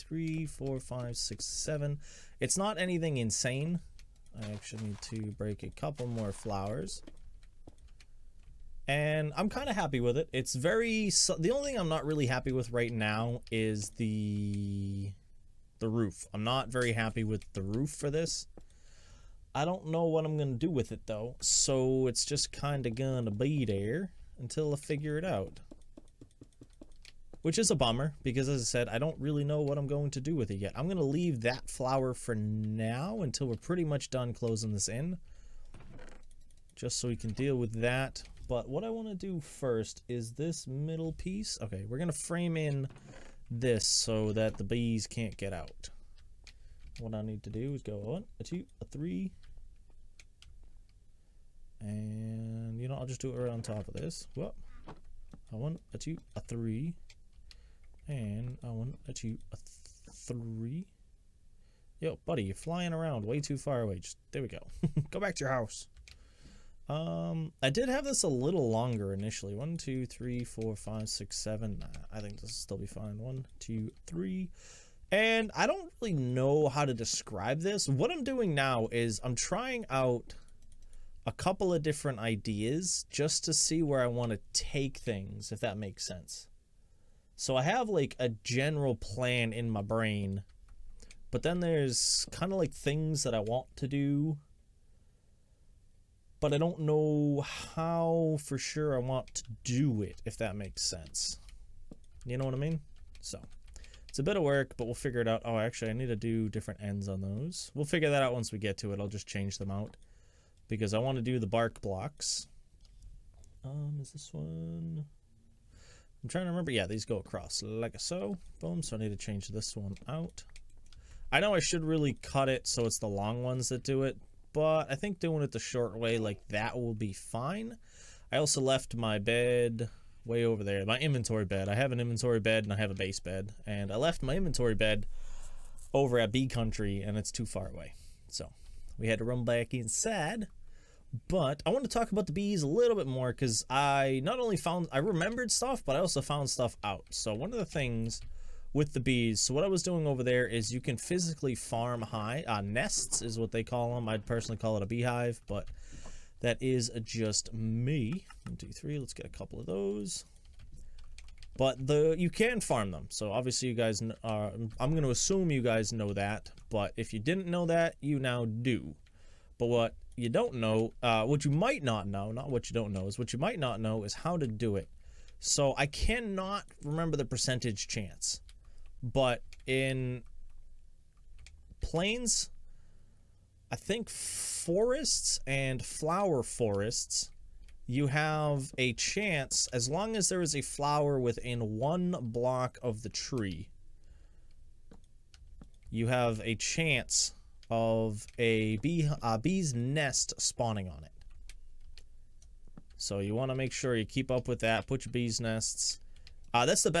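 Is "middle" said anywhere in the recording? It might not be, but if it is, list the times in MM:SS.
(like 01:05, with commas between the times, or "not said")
00:40.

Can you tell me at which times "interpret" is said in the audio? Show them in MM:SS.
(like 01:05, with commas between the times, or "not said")
not said.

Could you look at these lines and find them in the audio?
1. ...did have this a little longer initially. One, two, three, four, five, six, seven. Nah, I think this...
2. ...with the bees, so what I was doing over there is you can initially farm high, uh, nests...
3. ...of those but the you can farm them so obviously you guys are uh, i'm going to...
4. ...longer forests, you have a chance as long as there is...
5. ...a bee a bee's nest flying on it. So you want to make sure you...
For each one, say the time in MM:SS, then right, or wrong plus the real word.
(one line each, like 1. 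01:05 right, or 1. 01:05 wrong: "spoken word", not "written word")
1. 01:07 right
2. 02:28 wrong: "physically", not "initially"
3. 02:39 right
4. 03:05 wrong: "flower", not "longer"
5. 03:18 wrong: "spawning", not "flying".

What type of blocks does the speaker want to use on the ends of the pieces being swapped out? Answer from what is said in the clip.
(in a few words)
Bark blocks.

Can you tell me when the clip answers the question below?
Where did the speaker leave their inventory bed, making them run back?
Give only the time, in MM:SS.
02:16.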